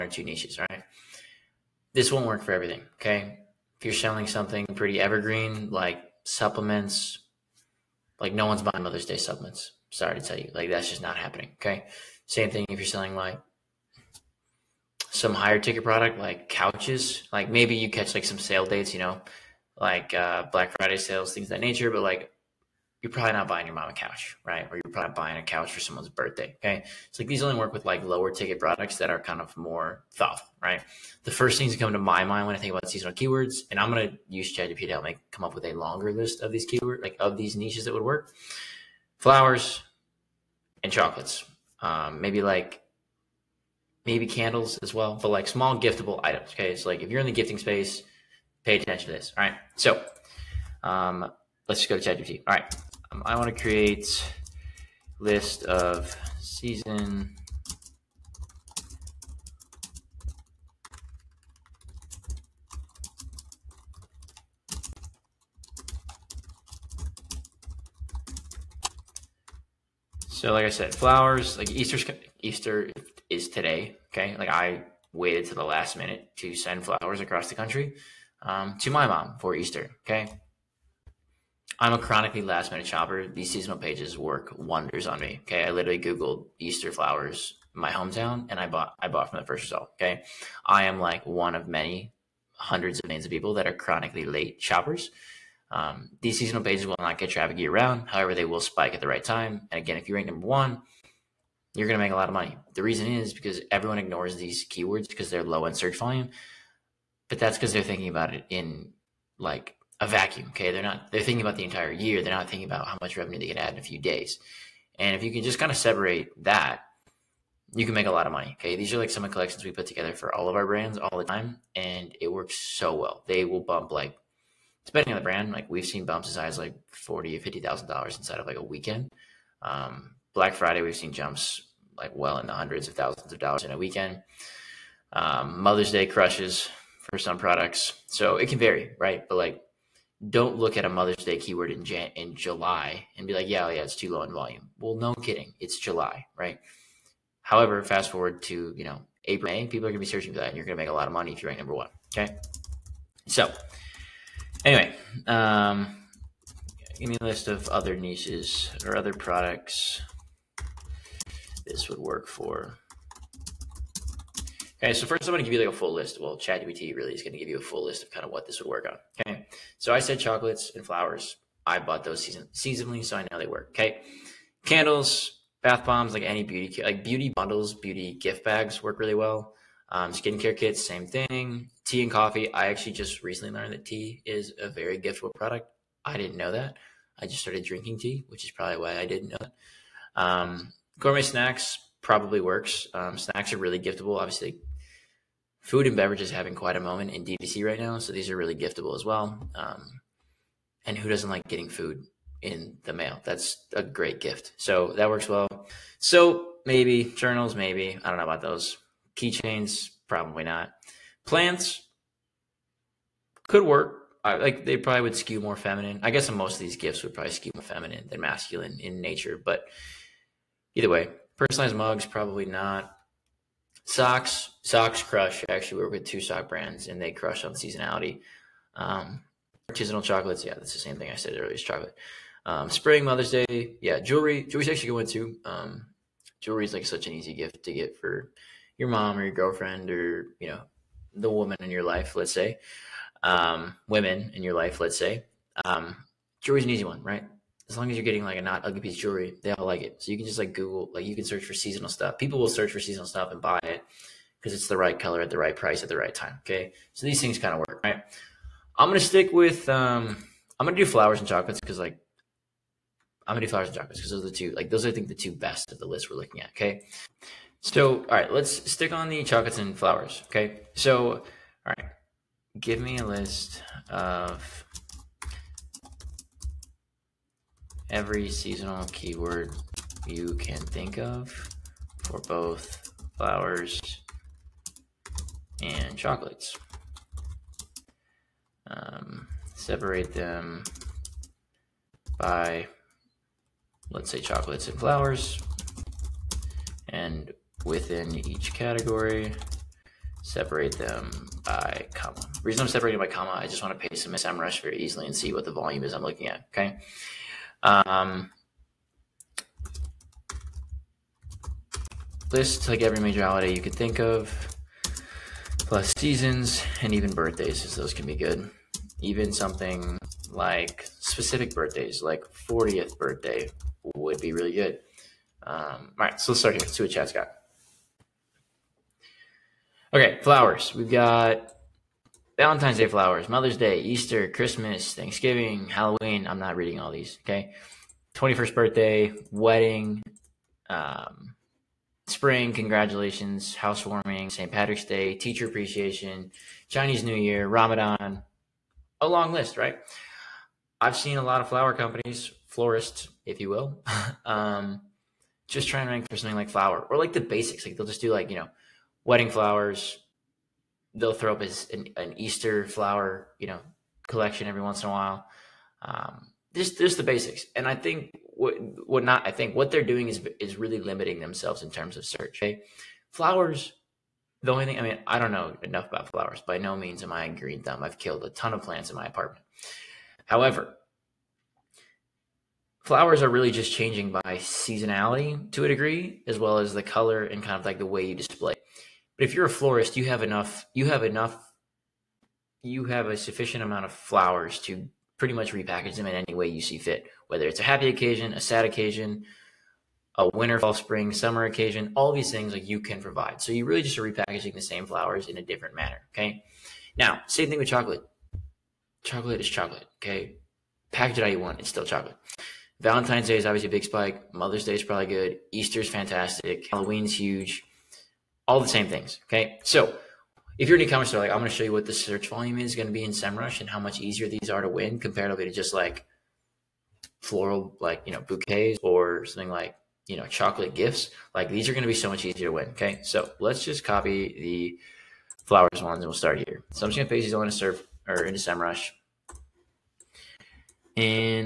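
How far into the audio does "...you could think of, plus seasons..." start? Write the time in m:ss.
5:13.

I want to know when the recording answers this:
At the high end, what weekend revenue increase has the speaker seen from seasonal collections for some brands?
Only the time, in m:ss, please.
2:06.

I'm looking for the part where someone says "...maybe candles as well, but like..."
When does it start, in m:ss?
0:44.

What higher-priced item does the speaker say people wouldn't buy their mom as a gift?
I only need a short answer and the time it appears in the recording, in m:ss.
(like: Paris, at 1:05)
Couches, at 0:16.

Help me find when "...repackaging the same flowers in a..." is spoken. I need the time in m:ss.
6:44.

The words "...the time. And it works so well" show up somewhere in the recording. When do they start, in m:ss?
2:01.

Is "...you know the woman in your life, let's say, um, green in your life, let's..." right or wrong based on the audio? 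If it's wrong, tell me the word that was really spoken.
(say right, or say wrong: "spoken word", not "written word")
wrong: "women", not "green".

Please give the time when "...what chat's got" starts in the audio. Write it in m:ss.
5:26.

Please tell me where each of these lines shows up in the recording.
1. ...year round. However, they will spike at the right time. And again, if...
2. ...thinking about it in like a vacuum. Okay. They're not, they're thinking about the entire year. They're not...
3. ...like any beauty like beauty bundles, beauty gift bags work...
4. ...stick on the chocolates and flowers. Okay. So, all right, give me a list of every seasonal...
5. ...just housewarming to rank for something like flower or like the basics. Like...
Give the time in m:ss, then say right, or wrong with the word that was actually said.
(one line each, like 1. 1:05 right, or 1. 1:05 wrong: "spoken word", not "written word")
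1. 1:37 right
2. 1:47 right
3. 2:56 right
4. 4:28 right
5. 5:55 wrong: "trying", not "housewarming".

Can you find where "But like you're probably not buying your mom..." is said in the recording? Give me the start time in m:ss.
0:21.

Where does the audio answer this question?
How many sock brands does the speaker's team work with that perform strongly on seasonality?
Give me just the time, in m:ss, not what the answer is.
3:46.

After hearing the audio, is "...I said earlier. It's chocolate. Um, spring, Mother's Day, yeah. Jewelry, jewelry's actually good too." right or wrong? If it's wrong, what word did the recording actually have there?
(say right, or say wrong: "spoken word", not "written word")
right.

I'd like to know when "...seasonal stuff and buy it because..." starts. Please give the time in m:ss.
4:12.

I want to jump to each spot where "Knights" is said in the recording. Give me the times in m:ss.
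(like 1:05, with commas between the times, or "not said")
not said.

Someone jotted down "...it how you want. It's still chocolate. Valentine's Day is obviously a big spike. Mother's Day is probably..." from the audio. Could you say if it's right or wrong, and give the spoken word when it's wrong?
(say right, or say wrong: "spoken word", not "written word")
right.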